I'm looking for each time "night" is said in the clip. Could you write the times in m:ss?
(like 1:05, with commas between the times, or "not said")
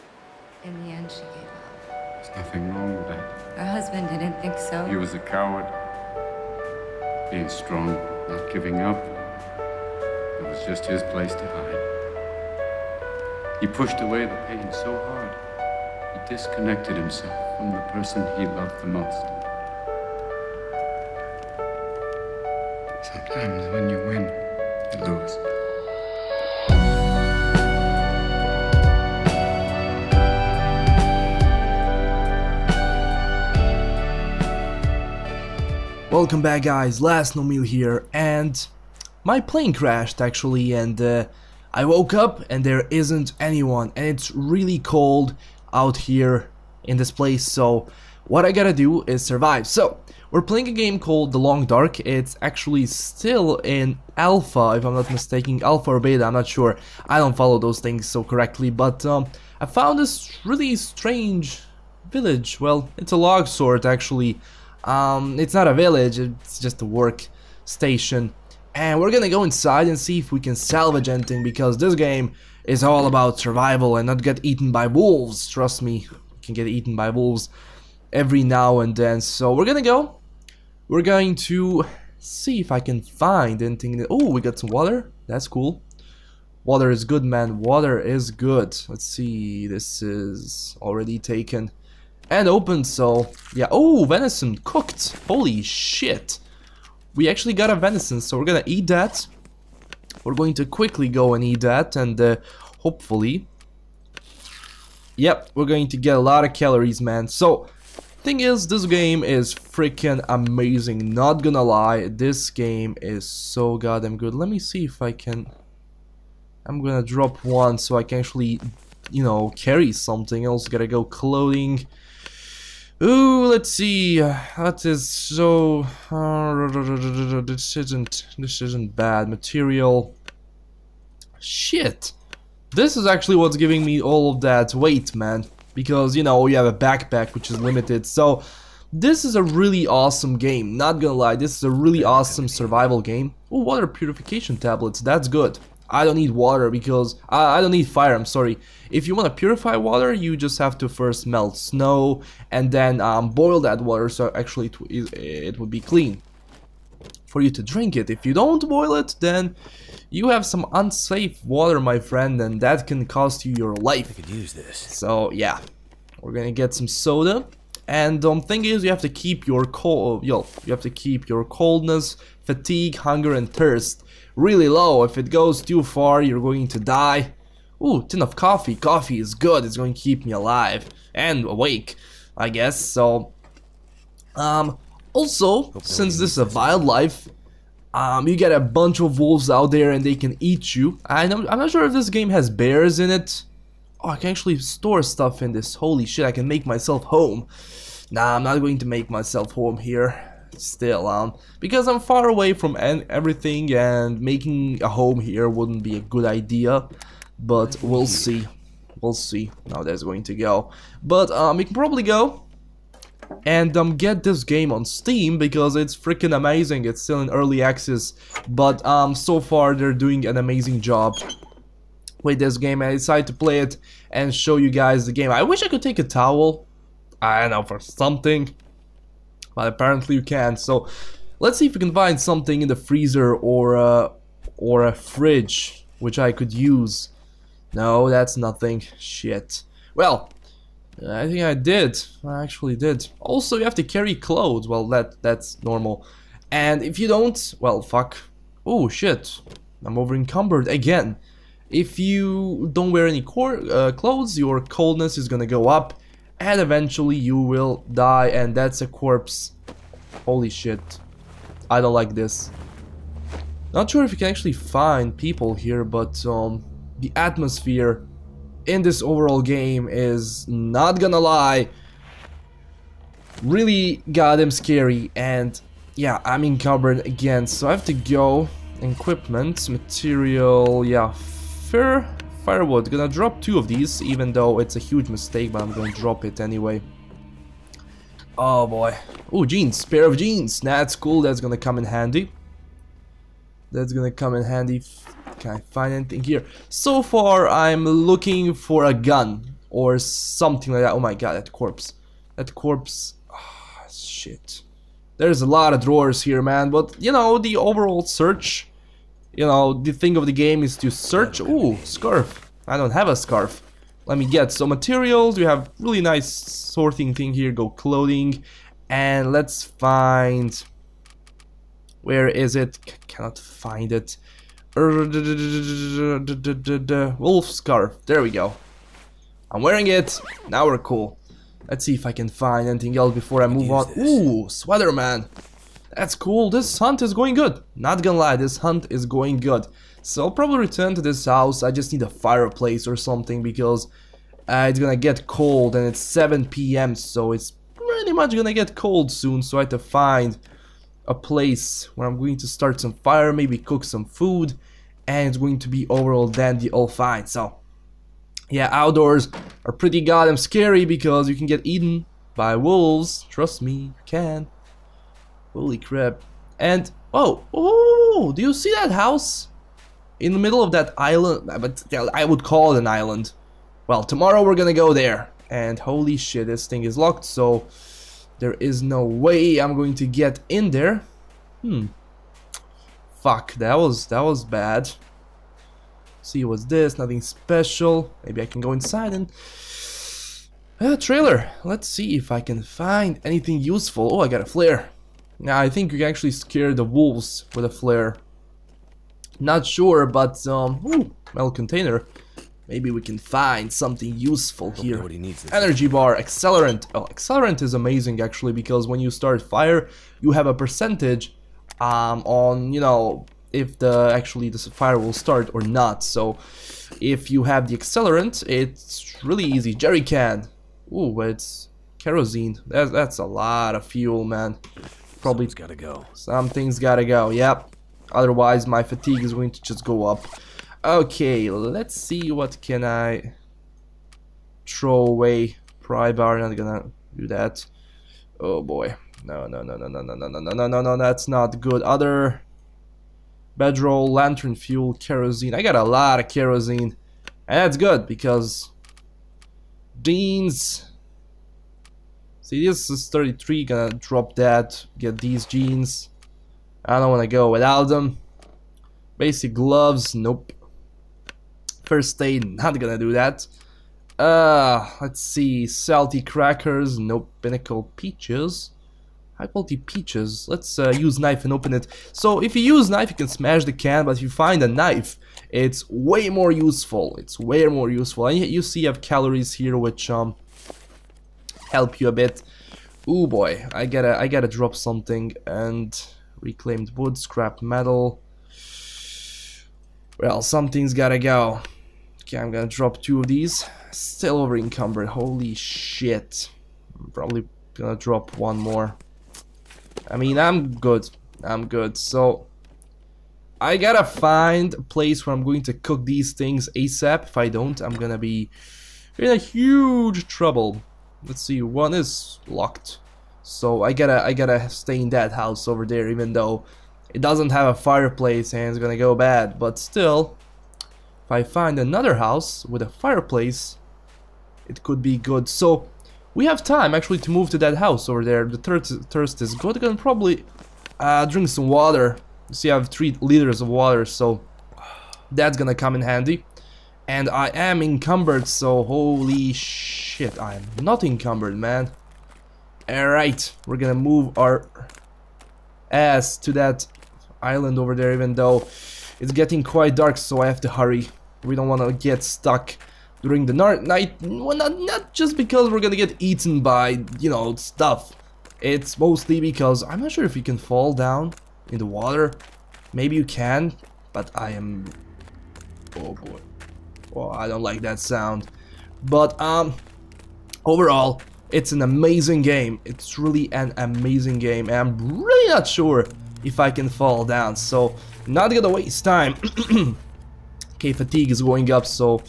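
9:13.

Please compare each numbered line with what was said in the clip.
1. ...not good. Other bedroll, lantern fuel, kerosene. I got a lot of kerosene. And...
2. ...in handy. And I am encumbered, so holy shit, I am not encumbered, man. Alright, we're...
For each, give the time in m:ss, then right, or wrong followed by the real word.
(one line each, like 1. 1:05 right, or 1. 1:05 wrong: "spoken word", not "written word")
1. 7:21 right
2. 8:55 right.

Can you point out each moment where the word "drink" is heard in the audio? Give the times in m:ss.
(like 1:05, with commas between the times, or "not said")
2:37, 8:51.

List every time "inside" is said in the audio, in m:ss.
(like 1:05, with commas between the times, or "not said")
1:09, 6:28.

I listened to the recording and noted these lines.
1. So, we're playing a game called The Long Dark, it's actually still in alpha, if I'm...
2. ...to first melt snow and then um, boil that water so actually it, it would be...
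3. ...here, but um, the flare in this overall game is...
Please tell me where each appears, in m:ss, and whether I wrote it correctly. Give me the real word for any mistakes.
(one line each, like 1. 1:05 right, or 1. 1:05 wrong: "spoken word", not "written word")
1. 0:49 right
2. 2:30 right
3. 4:25 wrong: "atmosphere", not "flare".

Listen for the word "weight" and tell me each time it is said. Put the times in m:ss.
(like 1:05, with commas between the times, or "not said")
2:14.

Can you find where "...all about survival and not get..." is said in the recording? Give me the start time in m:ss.
1:12.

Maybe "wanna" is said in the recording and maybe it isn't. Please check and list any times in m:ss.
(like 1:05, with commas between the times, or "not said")
7:37, 9:11.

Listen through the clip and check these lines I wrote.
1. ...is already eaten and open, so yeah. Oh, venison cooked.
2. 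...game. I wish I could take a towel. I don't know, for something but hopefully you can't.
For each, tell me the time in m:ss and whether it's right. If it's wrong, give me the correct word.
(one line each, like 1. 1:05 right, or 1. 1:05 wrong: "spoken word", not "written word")
1. 1:30 wrong: "taken", not "eaten"
2. 3:45 wrong: "apparently", not "hopefully".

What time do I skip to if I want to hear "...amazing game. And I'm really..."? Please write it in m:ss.
9:33.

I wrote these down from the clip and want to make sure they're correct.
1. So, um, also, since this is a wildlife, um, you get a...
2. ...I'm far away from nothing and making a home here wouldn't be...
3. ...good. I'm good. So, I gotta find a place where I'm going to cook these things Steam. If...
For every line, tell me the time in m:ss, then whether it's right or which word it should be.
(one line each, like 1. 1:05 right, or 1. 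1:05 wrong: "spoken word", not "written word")
1. 3:02 right
2. 3:21 wrong: "everything", not "nothing"
3. 8:20 wrong: "ASAP", not "Steam".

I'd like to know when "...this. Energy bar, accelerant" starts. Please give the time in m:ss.
6:45.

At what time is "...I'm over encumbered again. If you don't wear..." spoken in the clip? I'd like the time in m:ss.
4:09.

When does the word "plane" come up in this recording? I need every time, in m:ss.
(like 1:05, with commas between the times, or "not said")
0:39.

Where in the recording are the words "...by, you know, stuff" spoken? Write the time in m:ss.
9:16.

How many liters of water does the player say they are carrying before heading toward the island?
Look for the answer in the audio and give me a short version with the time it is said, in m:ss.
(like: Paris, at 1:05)
3, at 8:52.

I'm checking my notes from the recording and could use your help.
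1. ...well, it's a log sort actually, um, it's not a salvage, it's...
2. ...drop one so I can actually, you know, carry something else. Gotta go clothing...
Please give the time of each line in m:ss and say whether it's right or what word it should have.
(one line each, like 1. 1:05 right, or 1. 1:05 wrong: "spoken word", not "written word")
1. 1:02 wrong: "village", not "salvage"
2. 1:57 right.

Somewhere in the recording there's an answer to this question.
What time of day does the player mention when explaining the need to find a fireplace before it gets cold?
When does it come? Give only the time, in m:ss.
5:46.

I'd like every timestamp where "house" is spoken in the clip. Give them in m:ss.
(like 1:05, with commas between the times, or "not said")
5:41, 6:08, 8:35, 8:42, 8:47.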